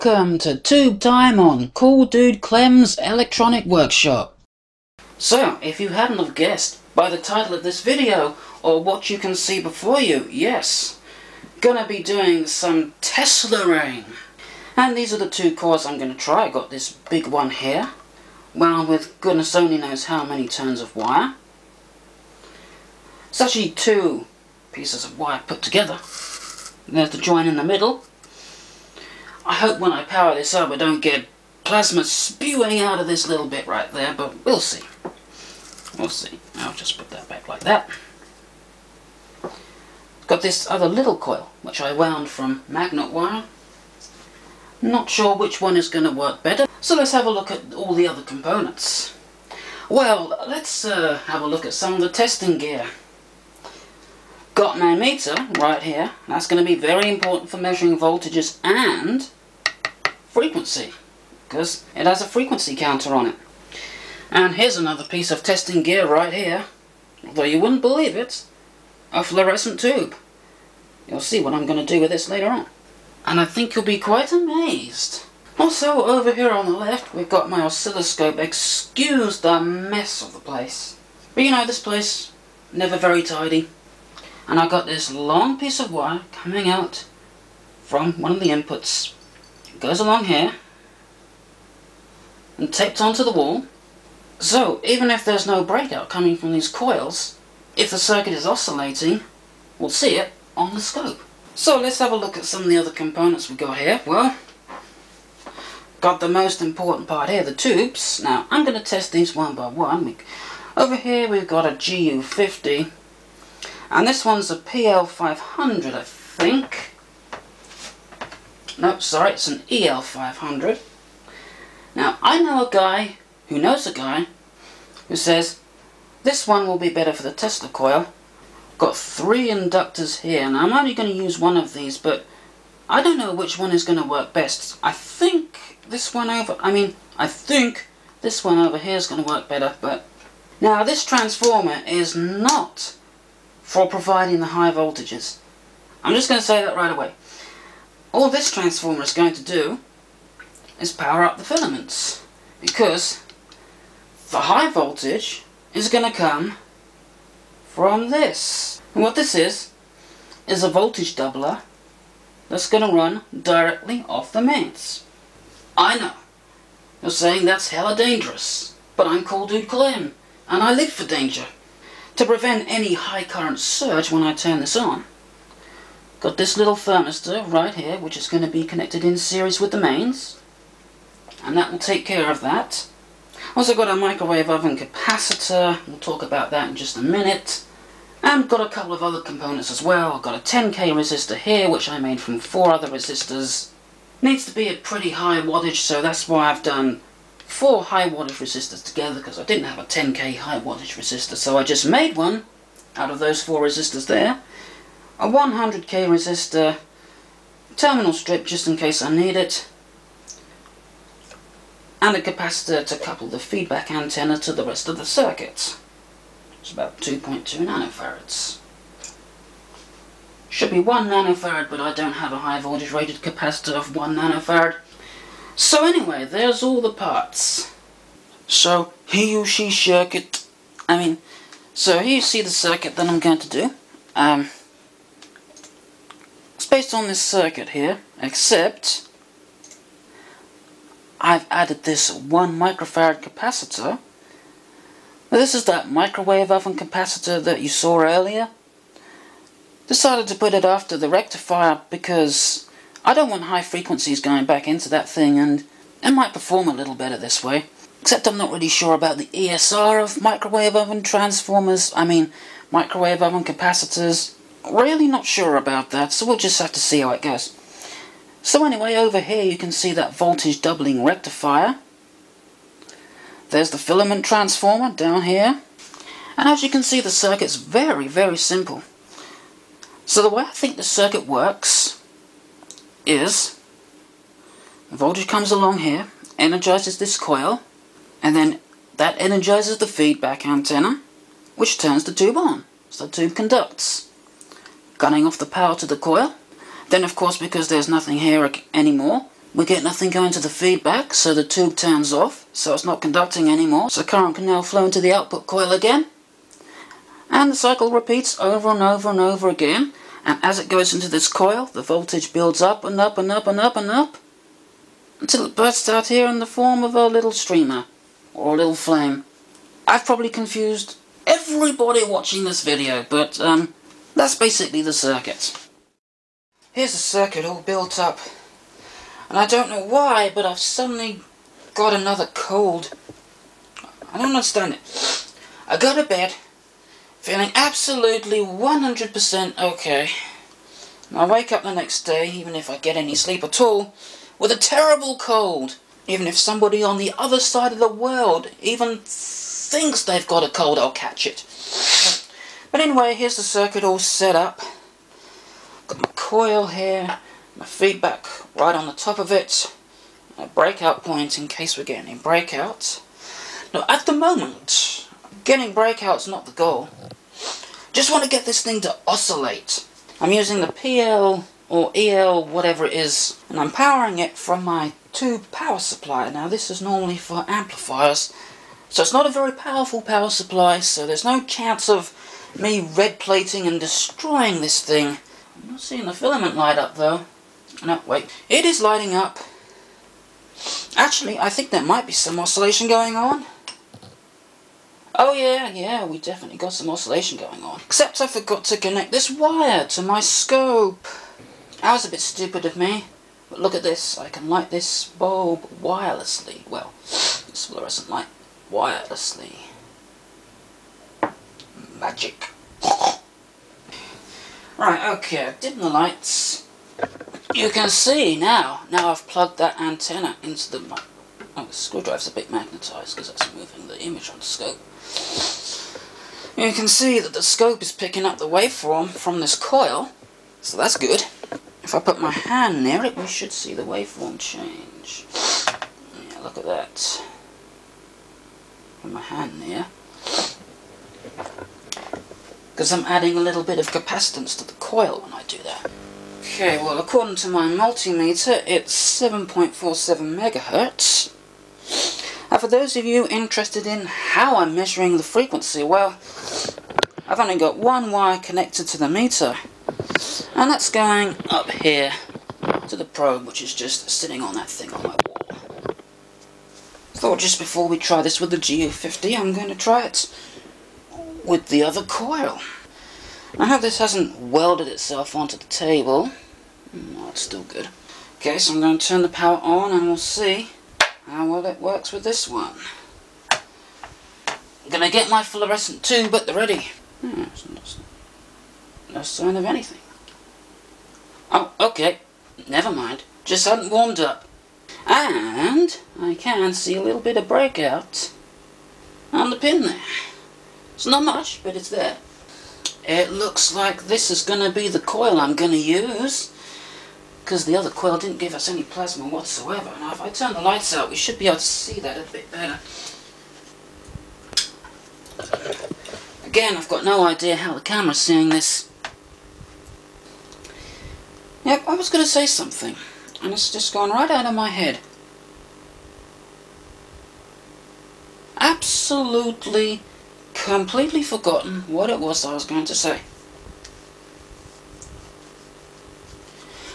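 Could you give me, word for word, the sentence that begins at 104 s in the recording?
Well, got the most important part here, the tubes.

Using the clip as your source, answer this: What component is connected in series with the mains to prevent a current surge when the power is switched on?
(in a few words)
thermistor.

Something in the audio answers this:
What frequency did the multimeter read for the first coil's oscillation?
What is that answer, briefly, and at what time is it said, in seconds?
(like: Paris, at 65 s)
7.47 MHz, at 449 s.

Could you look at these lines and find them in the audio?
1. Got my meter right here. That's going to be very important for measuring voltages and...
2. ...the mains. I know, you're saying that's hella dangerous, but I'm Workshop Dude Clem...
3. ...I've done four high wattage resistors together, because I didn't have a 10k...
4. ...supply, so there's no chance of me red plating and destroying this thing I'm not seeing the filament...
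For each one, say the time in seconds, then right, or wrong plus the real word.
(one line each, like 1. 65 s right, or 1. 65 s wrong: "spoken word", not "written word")
1. 54 s right
2. 164 s wrong: "Cool", not "Workshop"
3. 196 s right
4. 380 s right.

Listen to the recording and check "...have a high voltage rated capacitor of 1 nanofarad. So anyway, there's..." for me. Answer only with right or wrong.
right.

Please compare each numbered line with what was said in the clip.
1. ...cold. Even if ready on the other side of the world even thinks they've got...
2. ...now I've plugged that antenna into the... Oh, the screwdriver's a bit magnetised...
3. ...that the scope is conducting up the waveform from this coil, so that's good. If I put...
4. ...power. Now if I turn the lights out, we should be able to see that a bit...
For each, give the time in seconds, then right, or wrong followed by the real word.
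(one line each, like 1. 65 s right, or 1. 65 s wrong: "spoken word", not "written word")
1. 345 s wrong: "somebody", not "ready"
2. 418 s right
3. 427 s wrong: "picking", not "conducting"
4. 509 s wrong: "whatsoever", not "power".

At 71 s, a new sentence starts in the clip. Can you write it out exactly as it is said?
You'll see what I'm going to do with this later on.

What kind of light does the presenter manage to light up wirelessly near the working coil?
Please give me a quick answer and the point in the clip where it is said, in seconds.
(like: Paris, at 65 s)
fluorescent light, at 407 s.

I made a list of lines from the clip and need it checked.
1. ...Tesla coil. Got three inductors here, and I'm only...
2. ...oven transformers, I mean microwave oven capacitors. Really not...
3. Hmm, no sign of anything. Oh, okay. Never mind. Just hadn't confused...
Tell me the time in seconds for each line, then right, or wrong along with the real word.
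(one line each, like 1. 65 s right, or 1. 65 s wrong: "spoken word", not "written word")
1. 127 s right
2. 260 s right
3. 487 s wrong: "warmed", not "confused".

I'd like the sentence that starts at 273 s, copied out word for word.
There's the filament transformer down here.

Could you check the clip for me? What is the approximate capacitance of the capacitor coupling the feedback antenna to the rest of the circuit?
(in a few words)
2.2 nanofarads.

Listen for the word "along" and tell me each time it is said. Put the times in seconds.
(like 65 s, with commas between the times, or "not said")
89 s, 285 s.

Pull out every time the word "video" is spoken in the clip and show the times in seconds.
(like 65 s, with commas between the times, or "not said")
7 s, 322 s.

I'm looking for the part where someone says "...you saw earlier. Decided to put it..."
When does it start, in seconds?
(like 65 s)
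247 s.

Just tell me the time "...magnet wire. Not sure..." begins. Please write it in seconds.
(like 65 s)
42 s.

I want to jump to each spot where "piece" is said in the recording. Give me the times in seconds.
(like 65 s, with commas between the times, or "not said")
24 s, 65 s, 85 s.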